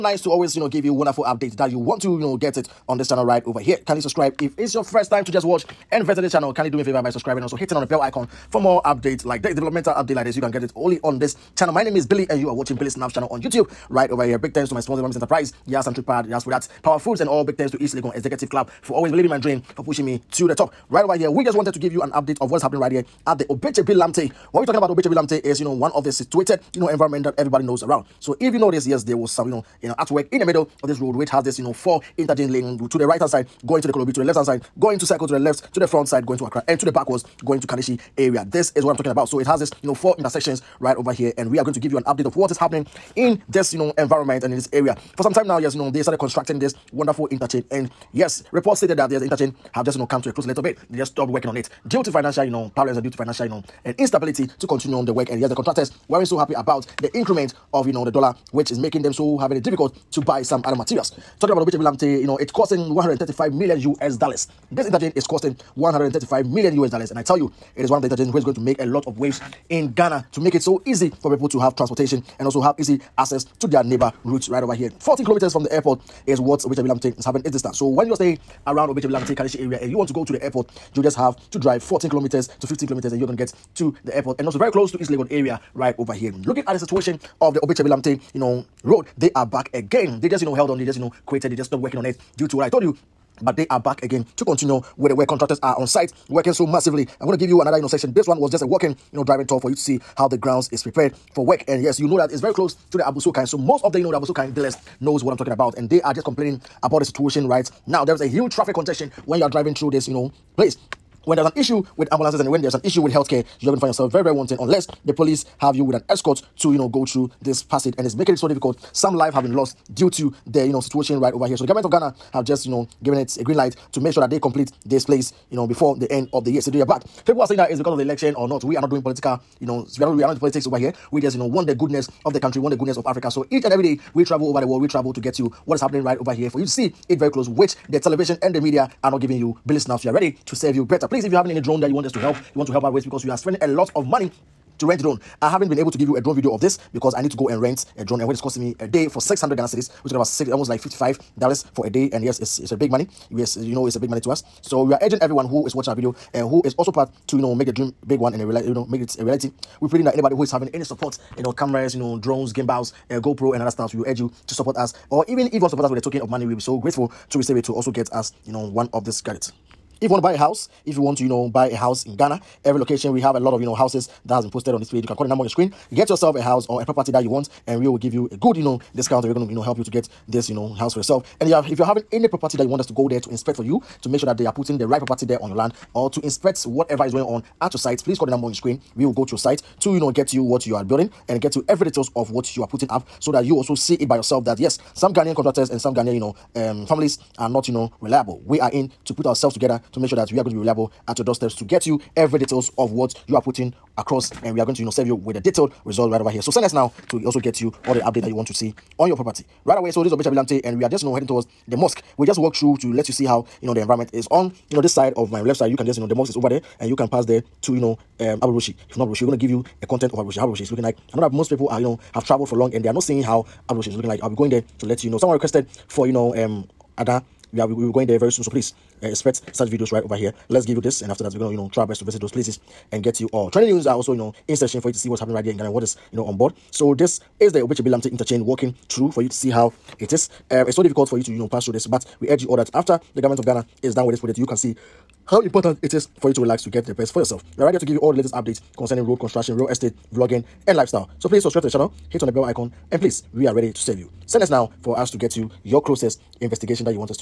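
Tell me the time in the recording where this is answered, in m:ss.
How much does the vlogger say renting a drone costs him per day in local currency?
2:29.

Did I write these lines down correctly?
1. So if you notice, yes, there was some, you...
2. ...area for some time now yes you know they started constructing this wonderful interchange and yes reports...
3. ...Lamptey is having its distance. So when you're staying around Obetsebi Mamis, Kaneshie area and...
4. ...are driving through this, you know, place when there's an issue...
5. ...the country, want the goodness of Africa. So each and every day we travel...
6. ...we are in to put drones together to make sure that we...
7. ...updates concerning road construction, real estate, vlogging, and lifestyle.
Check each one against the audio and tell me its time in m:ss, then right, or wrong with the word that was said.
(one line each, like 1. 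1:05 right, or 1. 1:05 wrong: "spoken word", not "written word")
1. 0:28 right
2. 0:44 right
3. 1:16 wrong: "Lamptey", not "Mamis"
4. 1:49 right
5. 2:12 right
6. 3:18 wrong: "ourselves", not "drones"
7. 4:08 right.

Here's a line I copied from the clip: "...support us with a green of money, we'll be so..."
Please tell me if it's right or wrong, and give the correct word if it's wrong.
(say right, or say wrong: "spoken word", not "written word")
wrong: "token", not "green".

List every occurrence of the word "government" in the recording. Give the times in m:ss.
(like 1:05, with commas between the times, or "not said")
2:01, 4:03.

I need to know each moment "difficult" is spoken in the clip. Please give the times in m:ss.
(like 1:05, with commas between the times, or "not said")
0:59, 1:58, 4:00.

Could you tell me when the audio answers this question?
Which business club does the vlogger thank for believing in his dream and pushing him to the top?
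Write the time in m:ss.
0:17.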